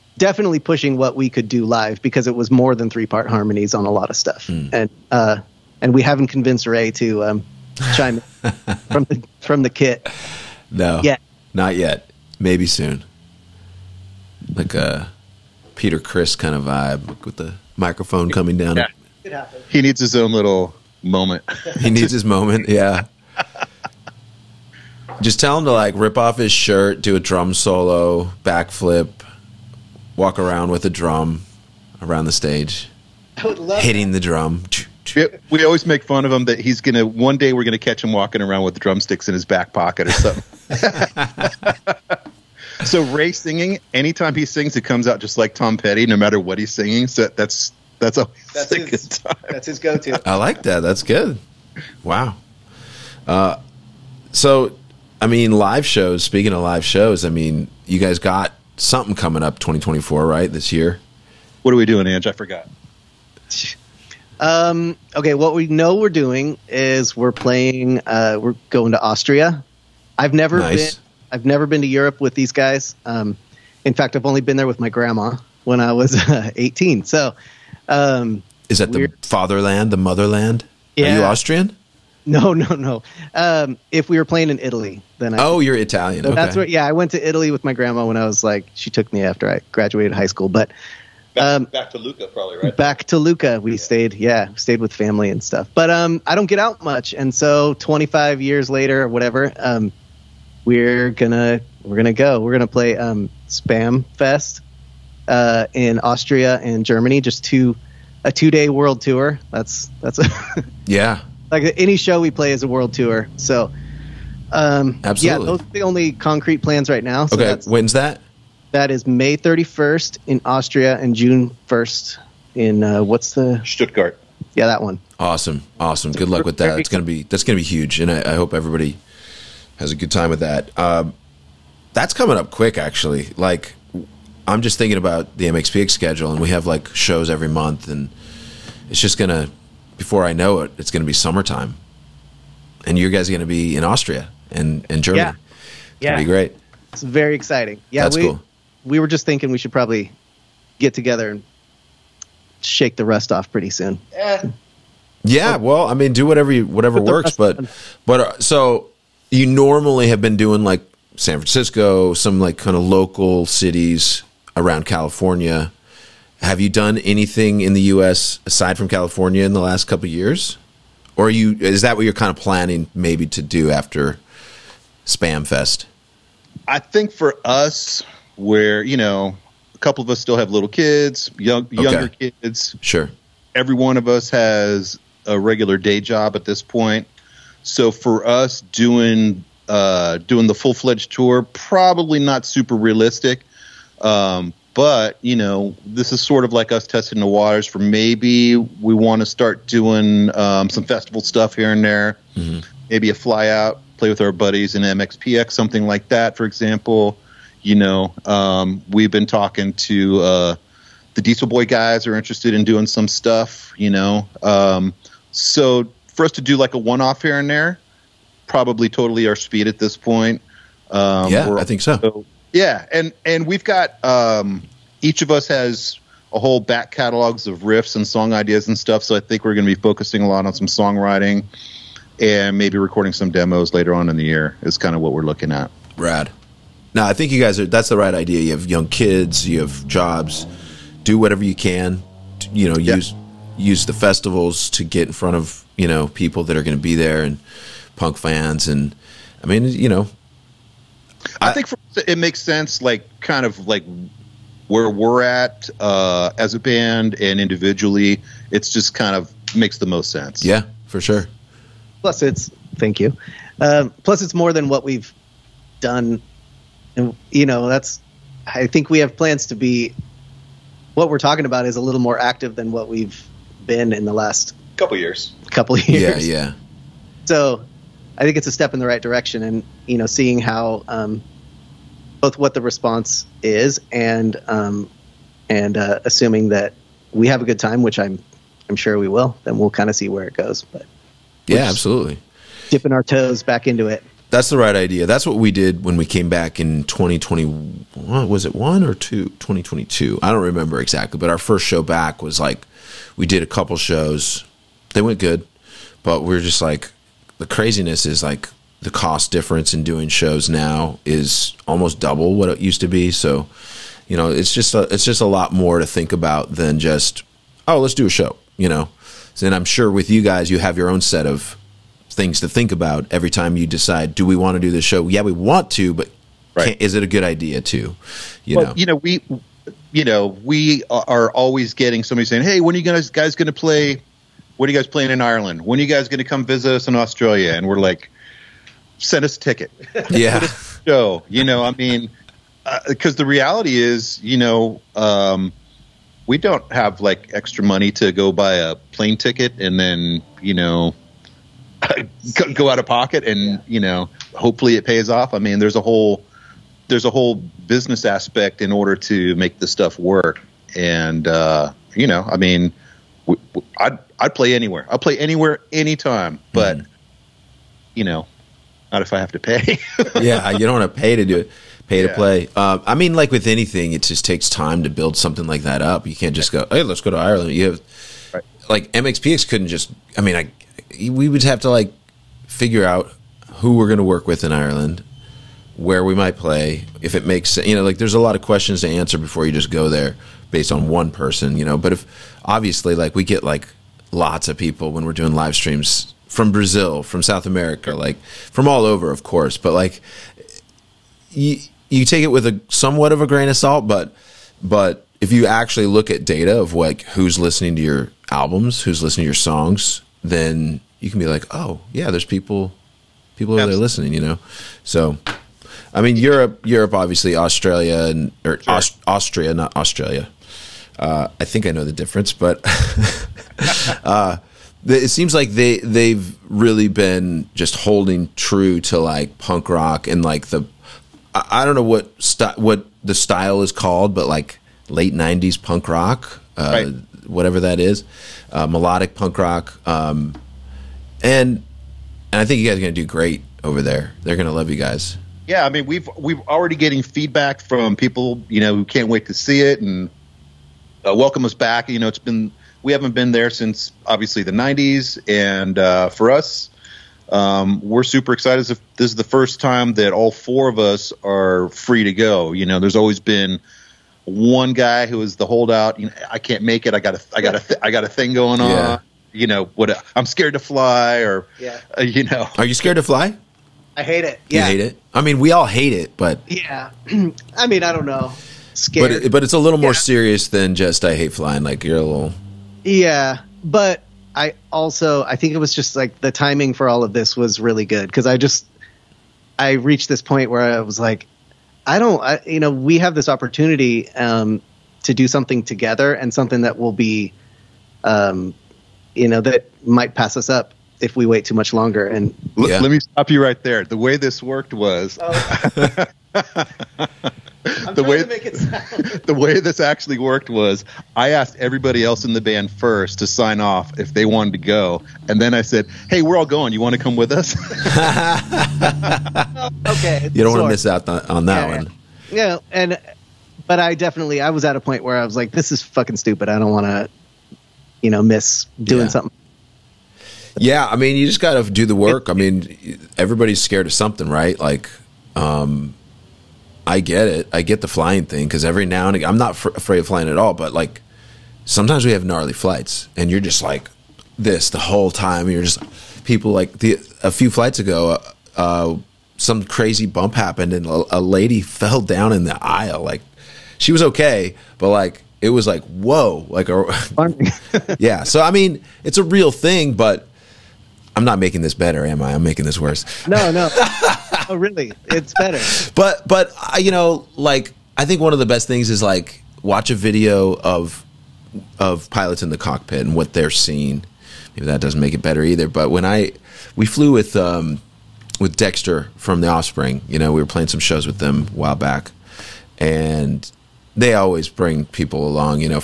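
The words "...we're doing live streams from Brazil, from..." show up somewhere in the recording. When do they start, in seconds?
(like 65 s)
395 s.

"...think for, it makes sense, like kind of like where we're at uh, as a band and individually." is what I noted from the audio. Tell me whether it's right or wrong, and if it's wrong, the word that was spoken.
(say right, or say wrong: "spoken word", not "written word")
right.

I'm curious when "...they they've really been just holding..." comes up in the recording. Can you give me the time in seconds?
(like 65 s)
425 s.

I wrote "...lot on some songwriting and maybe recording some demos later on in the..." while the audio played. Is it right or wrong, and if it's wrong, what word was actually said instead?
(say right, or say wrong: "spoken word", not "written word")
right.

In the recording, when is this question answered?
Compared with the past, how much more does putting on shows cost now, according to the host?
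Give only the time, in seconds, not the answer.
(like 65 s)
311 s.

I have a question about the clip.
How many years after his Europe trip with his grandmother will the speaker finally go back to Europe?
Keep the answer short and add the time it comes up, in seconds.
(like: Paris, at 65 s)
25, at 97 s.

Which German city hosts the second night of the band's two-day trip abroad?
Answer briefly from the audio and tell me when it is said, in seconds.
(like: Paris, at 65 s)
Stuttgart, at 123 s.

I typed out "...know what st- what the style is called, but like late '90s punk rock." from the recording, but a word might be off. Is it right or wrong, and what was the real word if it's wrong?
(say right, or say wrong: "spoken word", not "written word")
right.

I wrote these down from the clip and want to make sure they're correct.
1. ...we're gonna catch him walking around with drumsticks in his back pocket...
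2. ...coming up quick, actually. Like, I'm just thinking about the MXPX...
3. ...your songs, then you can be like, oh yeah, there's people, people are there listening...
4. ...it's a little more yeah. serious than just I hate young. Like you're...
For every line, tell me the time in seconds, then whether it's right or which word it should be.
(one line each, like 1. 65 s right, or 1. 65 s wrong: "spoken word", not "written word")
1. 37 s right
2. 132 s right
3. 409 s right
4. 479 s wrong: "flying", not "young".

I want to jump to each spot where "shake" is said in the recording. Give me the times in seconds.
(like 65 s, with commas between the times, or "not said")
152 s.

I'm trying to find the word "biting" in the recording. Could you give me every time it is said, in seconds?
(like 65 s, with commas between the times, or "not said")
not said.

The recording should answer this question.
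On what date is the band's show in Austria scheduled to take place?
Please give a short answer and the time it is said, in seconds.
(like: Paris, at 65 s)
May 31st, at 119 s.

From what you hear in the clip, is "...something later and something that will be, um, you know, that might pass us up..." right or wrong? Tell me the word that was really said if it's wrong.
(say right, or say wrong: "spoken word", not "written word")
wrong: "together", not "later".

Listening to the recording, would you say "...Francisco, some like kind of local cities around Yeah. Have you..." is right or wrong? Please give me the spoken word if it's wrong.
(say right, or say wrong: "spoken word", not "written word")
wrong: "California", not "Yeah".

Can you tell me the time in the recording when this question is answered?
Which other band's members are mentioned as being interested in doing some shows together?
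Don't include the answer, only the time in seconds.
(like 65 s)
211 s.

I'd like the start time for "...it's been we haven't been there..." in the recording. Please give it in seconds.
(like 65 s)
452 s.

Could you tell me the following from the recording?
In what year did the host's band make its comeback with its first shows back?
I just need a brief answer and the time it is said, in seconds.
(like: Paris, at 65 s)
2022, at 299 s.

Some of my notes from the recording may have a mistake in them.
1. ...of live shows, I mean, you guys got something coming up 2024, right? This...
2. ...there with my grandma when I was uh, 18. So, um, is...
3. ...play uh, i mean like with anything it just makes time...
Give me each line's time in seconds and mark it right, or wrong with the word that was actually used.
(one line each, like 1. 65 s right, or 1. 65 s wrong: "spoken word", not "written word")
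1. 56 s right
2. 74 s right
3. 372 s wrong: "takes", not "makes".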